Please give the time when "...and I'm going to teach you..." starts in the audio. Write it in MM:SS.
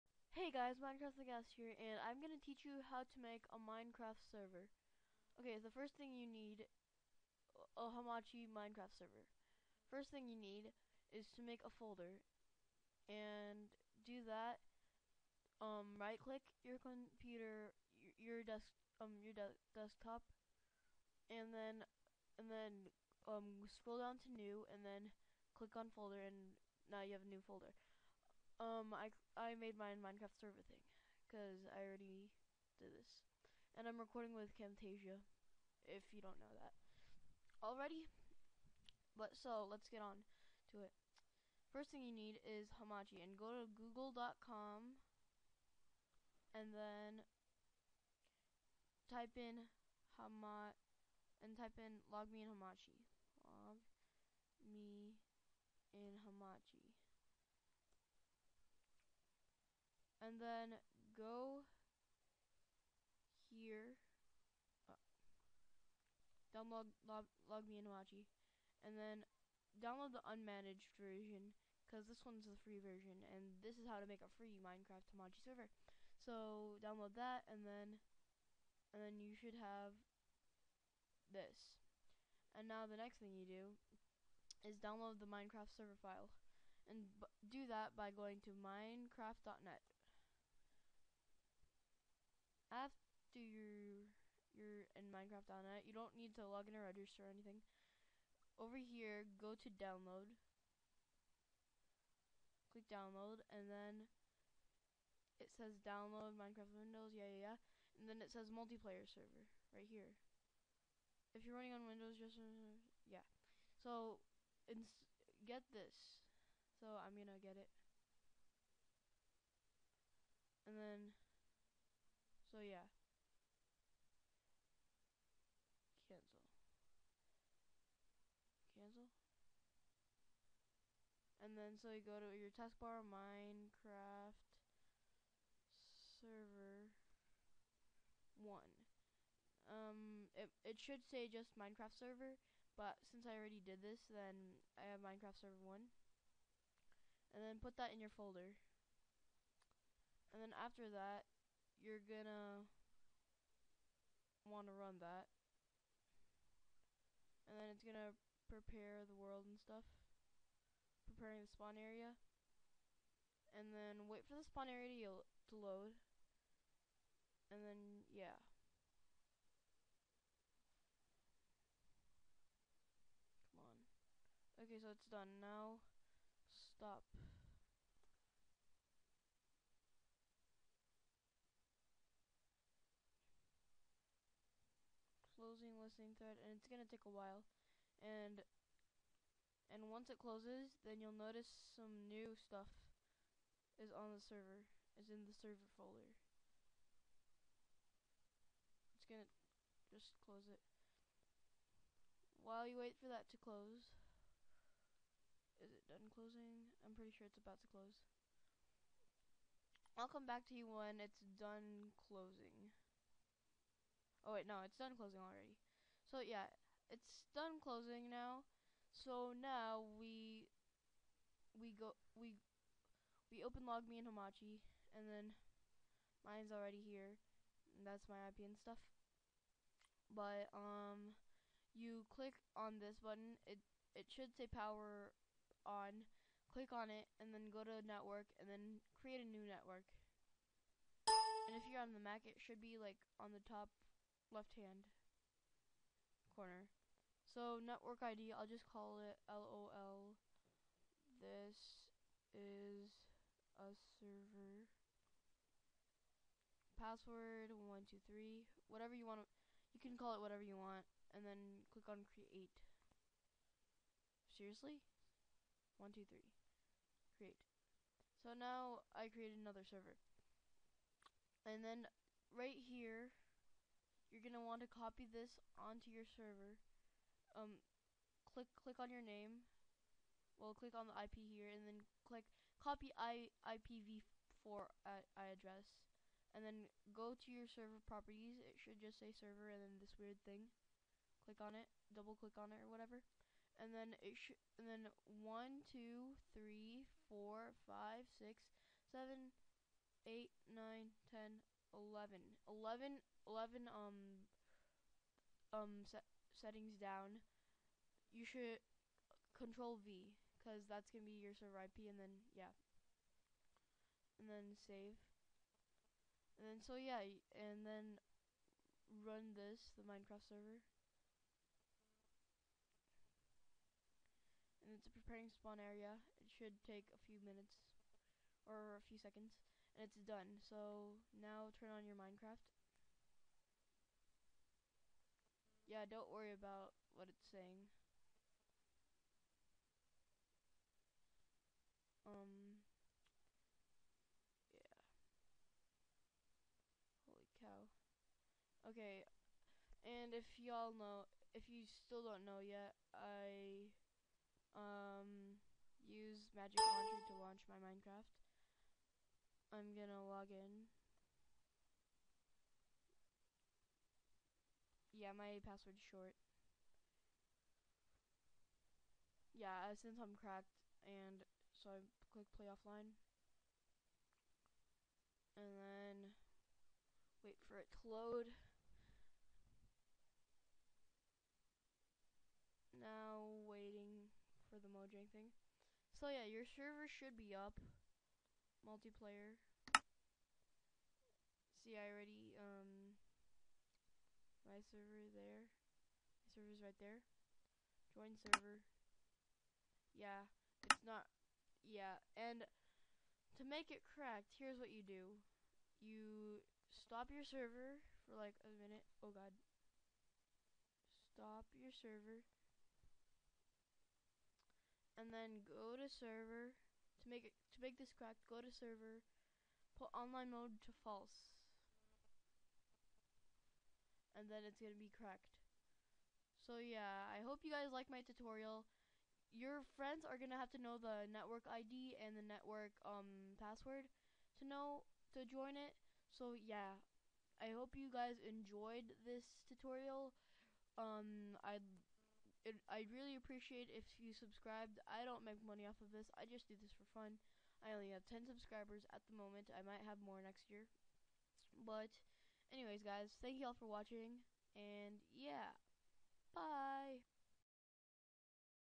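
00:01.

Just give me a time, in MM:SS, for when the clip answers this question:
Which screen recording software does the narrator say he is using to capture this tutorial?
00:34.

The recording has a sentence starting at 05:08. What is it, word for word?
You should control V because that's going to be your server IP and then, yeah.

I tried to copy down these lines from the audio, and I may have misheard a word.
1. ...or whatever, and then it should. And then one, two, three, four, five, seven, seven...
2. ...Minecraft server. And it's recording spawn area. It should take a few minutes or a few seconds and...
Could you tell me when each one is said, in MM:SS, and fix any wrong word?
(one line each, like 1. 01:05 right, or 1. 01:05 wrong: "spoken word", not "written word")
1. 04:52 wrong: "six", not "seven"
2. 05:19 wrong: "preparing", not "recording".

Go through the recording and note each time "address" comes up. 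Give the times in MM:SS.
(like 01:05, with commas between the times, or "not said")
04:45.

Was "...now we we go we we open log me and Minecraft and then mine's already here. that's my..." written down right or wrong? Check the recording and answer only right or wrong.
wrong.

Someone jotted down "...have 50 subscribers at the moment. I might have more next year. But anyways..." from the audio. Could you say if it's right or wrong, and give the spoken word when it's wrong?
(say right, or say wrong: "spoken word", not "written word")
wrong: "10", not "50".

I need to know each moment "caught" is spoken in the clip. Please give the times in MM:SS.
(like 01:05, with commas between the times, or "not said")
not said.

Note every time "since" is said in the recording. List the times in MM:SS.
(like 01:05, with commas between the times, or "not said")
02:23, 06:09.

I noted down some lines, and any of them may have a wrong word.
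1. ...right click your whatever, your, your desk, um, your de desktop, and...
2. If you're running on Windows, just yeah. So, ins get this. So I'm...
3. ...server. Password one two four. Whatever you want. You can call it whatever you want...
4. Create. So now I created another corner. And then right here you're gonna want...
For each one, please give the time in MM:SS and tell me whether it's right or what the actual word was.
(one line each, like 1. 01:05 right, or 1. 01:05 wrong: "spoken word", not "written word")
1. 00:15 wrong: "computer", not "whatever"
2. 01:51 right
3. 04:14 wrong: "three", not "four"
4. 04:27 wrong: "server", not "corner".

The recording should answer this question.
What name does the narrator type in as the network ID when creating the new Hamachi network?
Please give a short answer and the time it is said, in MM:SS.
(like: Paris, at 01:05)
LOL, at 04:09.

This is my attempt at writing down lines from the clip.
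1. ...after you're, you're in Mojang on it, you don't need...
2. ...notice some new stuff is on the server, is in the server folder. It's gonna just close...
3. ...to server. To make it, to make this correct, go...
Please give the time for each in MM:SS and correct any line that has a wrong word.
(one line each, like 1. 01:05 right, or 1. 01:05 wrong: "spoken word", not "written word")
1. 01:32 wrong: "Minecraft", not "Mojang"
2. 03:11 right
3. 06:55 right.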